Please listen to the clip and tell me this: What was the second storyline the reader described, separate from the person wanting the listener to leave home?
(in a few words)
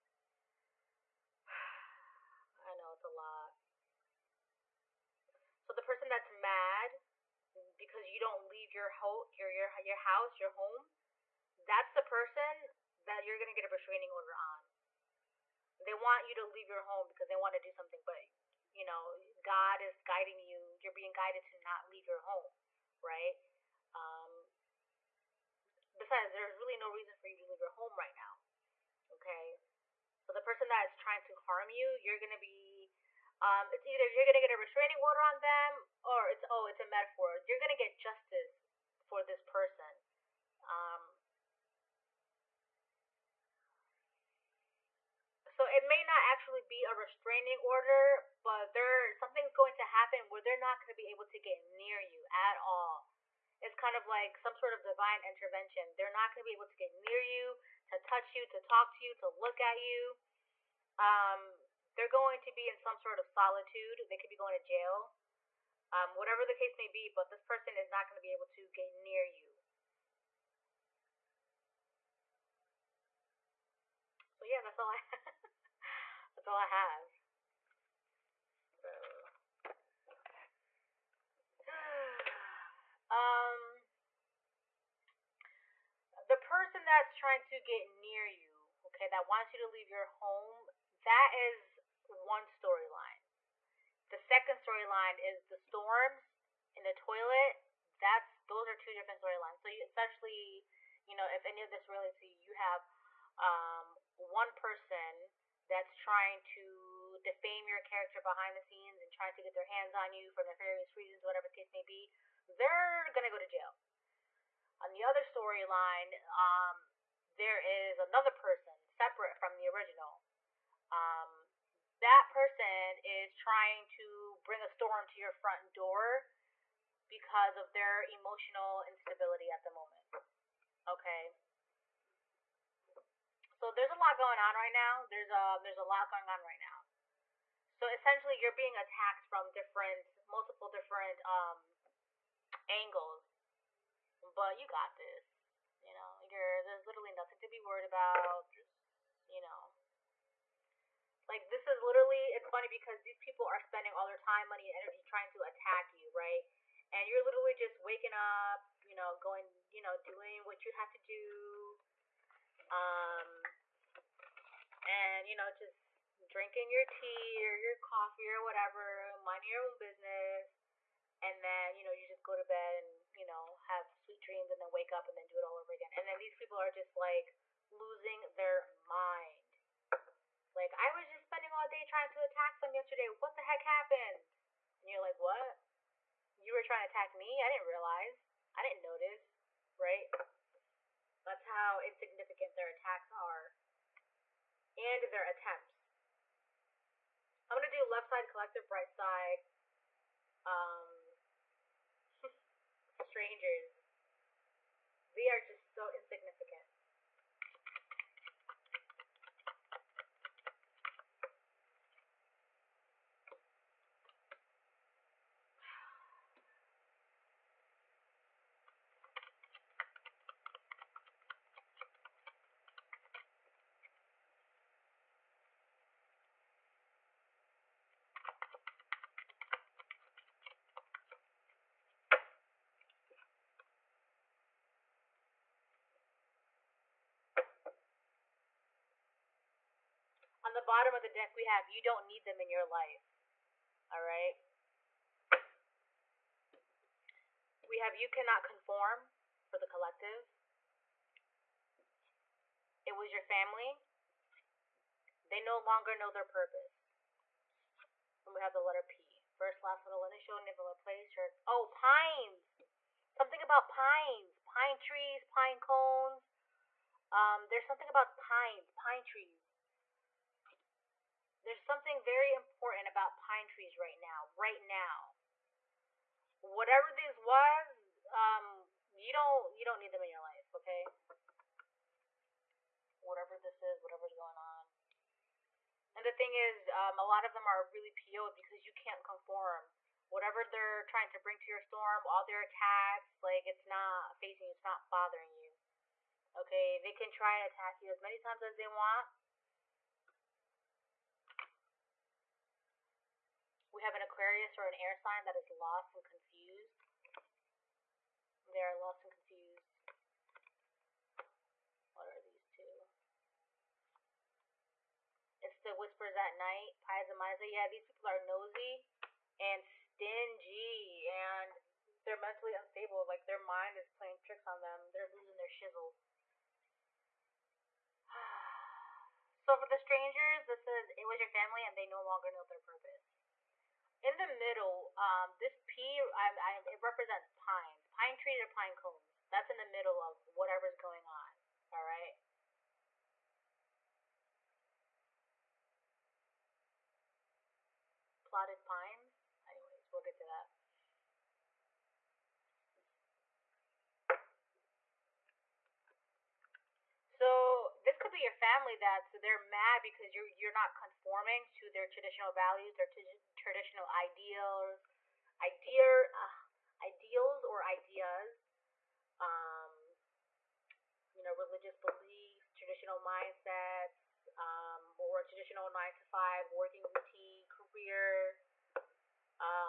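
storms in the toilet.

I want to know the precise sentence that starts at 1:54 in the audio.
On the other storyline, um, there is another person separate from the original.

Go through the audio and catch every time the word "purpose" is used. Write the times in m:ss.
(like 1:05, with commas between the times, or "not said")
4:16, 5:32.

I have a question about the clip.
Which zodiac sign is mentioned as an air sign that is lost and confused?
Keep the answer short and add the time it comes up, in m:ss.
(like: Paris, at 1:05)
Aquarius, at 5:04.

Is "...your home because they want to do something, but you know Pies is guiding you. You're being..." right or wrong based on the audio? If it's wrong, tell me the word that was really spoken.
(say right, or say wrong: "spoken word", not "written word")
wrong: "God", not "Pies".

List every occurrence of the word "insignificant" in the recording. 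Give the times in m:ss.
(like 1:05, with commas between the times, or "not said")
3:11, 3:25.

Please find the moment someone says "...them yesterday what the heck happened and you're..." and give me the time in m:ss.
3:02.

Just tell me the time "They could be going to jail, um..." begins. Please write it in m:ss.
1:04.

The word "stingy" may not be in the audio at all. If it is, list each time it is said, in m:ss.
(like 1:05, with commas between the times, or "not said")
5:19.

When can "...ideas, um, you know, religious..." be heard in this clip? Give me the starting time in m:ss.
6:07.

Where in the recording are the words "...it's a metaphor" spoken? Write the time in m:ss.
0:36.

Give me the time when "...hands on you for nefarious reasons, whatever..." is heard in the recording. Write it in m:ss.
1:49.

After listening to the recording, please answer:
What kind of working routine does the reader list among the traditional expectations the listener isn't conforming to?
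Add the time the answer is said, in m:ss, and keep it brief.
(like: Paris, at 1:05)
nine to five, at 6:15.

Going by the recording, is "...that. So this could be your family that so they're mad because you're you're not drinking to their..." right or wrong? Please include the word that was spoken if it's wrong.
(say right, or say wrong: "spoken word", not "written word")
wrong: "conforming", not "drinking".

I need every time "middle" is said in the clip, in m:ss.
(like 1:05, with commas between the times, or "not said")
5:34, 5:39.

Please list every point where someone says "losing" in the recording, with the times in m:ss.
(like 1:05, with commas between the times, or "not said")
2:57, 5:25.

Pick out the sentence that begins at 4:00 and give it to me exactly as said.
bottom of the deck we have you don't need them in your life.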